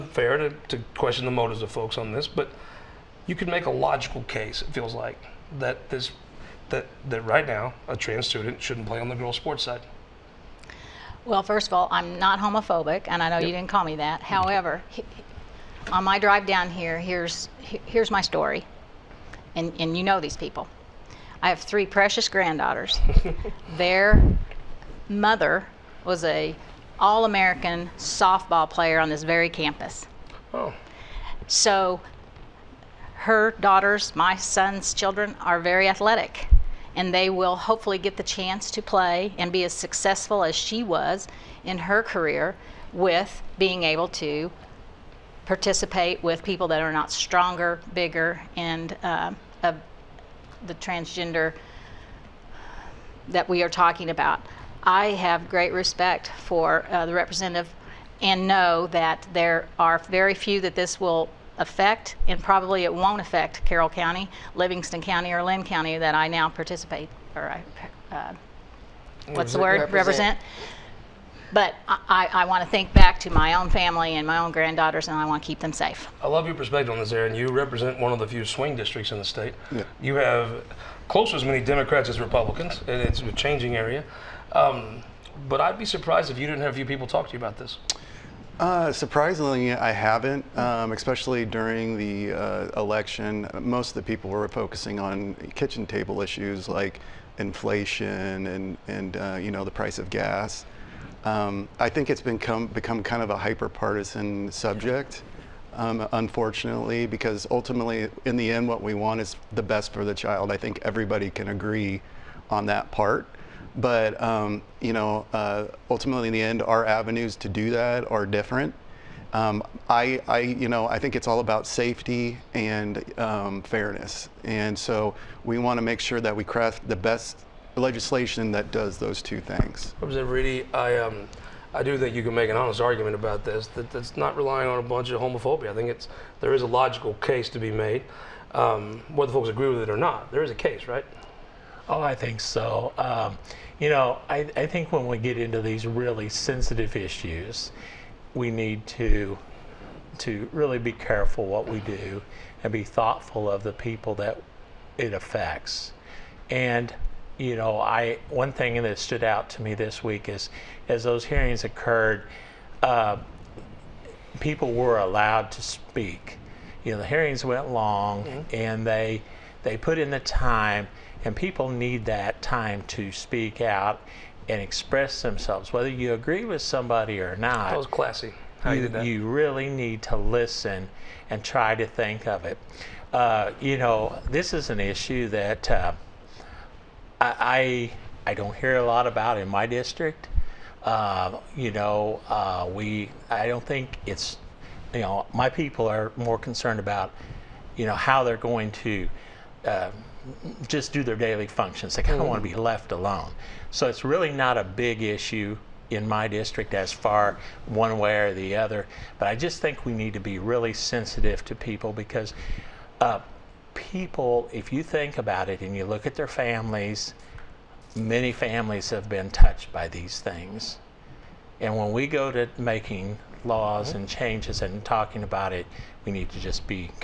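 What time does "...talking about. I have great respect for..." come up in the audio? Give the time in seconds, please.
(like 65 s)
53 s.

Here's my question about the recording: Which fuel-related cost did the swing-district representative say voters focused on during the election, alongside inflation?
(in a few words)
Price of gas.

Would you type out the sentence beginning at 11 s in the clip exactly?
Well, first of all, I'm not homophobic, and I know yep.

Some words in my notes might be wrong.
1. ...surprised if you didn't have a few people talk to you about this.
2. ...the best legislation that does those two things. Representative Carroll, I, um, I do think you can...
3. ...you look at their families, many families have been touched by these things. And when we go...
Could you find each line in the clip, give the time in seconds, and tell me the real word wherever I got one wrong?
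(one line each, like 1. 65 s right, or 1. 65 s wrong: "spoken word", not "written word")
1. 85 s right
2. 126 s wrong: "Reedy", not "Carroll"
3. 215 s right.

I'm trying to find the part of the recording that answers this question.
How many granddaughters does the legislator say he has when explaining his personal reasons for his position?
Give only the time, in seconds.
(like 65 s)
21 s.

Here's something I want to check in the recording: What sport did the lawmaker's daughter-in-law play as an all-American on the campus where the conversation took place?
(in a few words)
Softball.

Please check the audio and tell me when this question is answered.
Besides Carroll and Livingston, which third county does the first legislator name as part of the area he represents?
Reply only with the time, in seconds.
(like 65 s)
65 s.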